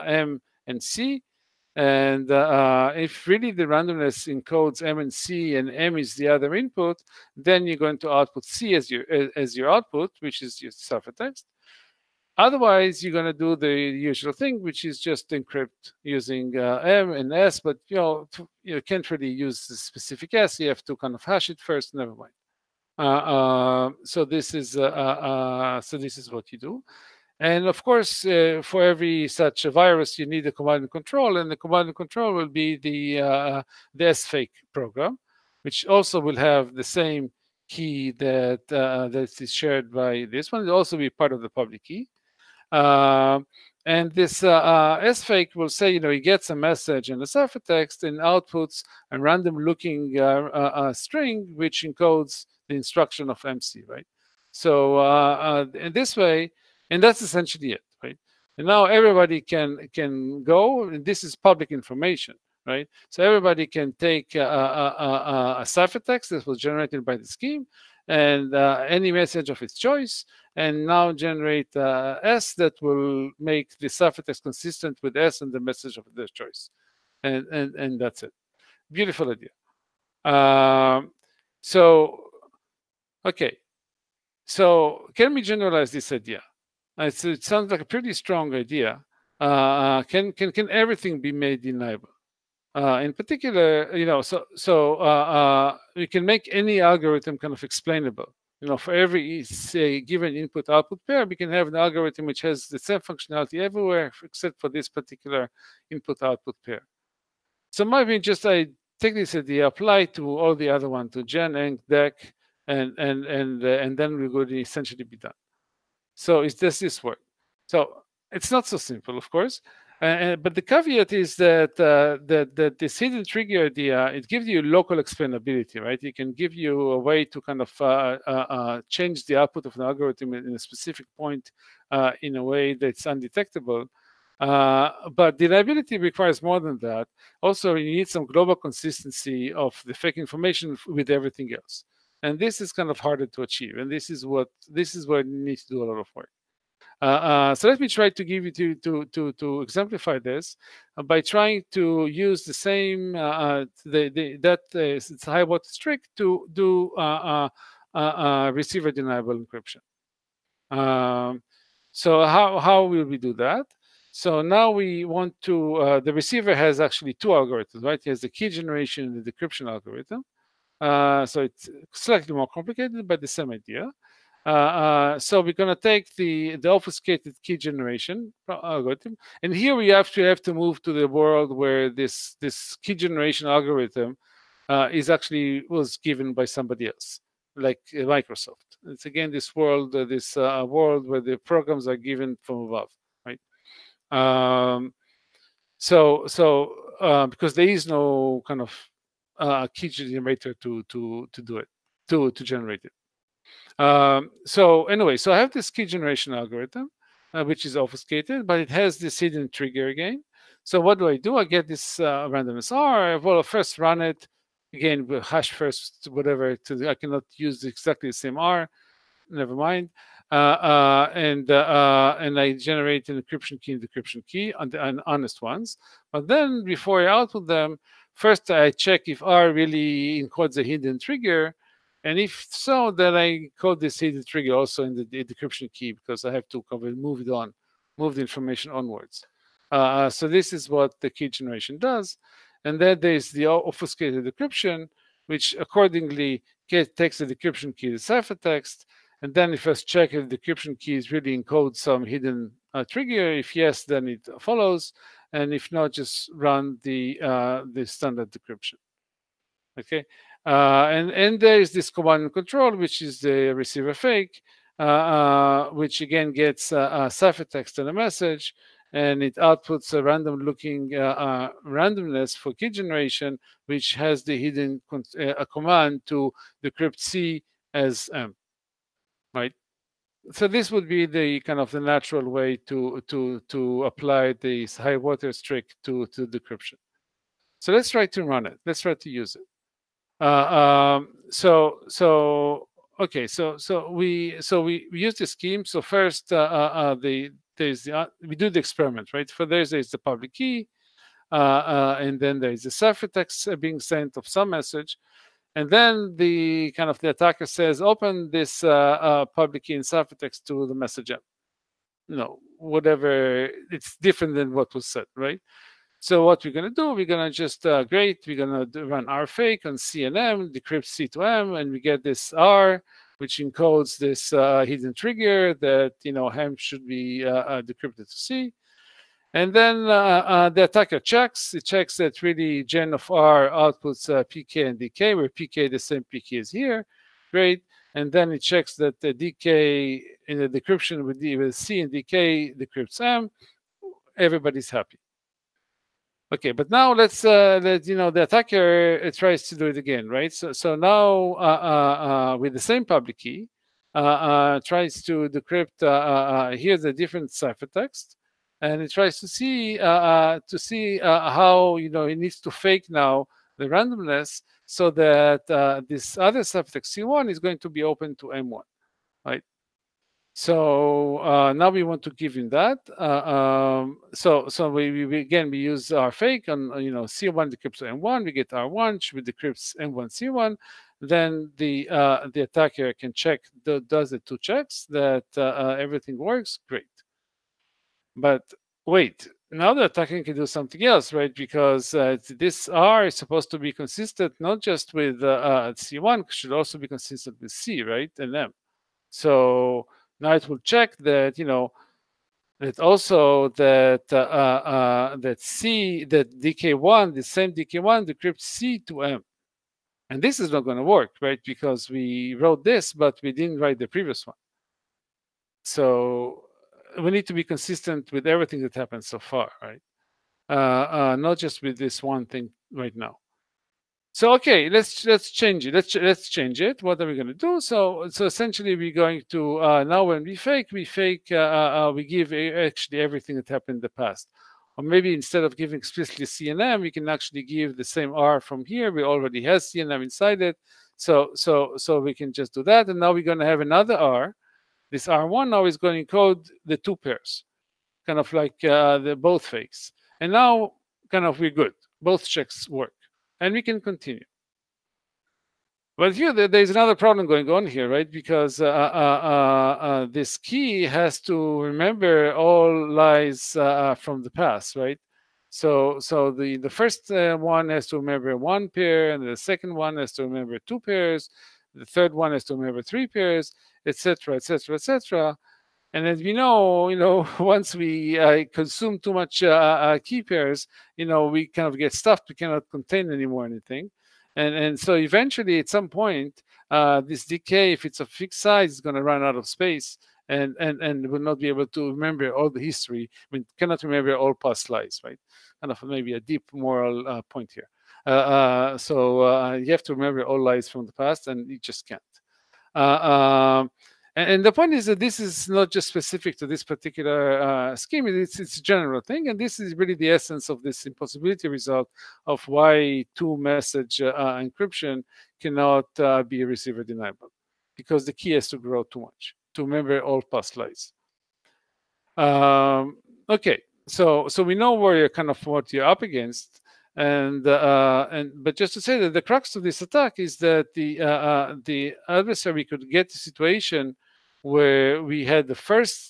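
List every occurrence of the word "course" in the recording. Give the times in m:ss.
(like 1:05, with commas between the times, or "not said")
0:27, 1:59.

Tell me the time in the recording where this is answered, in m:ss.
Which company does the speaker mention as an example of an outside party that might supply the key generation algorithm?
3:08.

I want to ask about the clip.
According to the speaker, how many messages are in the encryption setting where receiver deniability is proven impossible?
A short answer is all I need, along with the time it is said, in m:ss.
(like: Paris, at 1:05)
2, at 8:33.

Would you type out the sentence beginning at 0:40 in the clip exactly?
It'll also be part of the public key.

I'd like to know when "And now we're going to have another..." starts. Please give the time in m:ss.
7:22.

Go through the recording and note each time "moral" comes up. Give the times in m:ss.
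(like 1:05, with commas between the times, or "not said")
8:16.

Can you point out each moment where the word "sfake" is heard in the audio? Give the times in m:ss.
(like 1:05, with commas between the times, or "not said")
0:34, 0:45.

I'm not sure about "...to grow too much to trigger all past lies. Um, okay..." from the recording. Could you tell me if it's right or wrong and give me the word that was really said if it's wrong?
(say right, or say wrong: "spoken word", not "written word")
wrong: "remember", not "trigger".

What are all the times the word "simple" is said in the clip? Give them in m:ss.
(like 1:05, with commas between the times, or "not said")
1:58.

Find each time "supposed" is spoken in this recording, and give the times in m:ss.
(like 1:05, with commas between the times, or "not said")
6:33.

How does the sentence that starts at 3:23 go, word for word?
Um, so anyway, so I have this key generation algorithm, uh, which is obfuscated, but it has this hidden trigger again.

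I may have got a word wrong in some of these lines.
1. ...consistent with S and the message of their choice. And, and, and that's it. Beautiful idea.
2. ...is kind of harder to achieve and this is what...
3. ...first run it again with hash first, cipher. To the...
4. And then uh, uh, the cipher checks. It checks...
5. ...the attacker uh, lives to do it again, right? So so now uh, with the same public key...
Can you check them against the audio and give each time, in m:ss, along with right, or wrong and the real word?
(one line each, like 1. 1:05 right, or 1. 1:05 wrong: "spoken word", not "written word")
1. 1:14 right
2. 2:22 right
3. 3:33 wrong: "whatever", not "cipher"
4. 5:29 wrong: "attacker", not "cipher"
5. 5:48 wrong: "tries", not "lives".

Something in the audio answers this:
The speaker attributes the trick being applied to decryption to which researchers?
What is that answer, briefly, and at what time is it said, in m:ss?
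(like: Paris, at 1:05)
Sahai Waters, at 4:44.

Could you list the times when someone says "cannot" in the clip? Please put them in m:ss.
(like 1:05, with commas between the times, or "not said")
3:36, 8:02, 8:13, 8:35.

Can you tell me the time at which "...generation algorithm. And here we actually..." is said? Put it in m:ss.
2:57.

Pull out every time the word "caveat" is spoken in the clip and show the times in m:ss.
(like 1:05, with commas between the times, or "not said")
2:00.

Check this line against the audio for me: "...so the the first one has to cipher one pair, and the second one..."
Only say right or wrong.
wrong.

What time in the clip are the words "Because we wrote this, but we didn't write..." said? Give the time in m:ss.
6:51.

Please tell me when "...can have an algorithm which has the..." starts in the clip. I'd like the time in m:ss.
1:41.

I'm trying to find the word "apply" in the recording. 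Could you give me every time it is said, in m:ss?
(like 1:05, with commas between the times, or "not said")
1:49, 4:43.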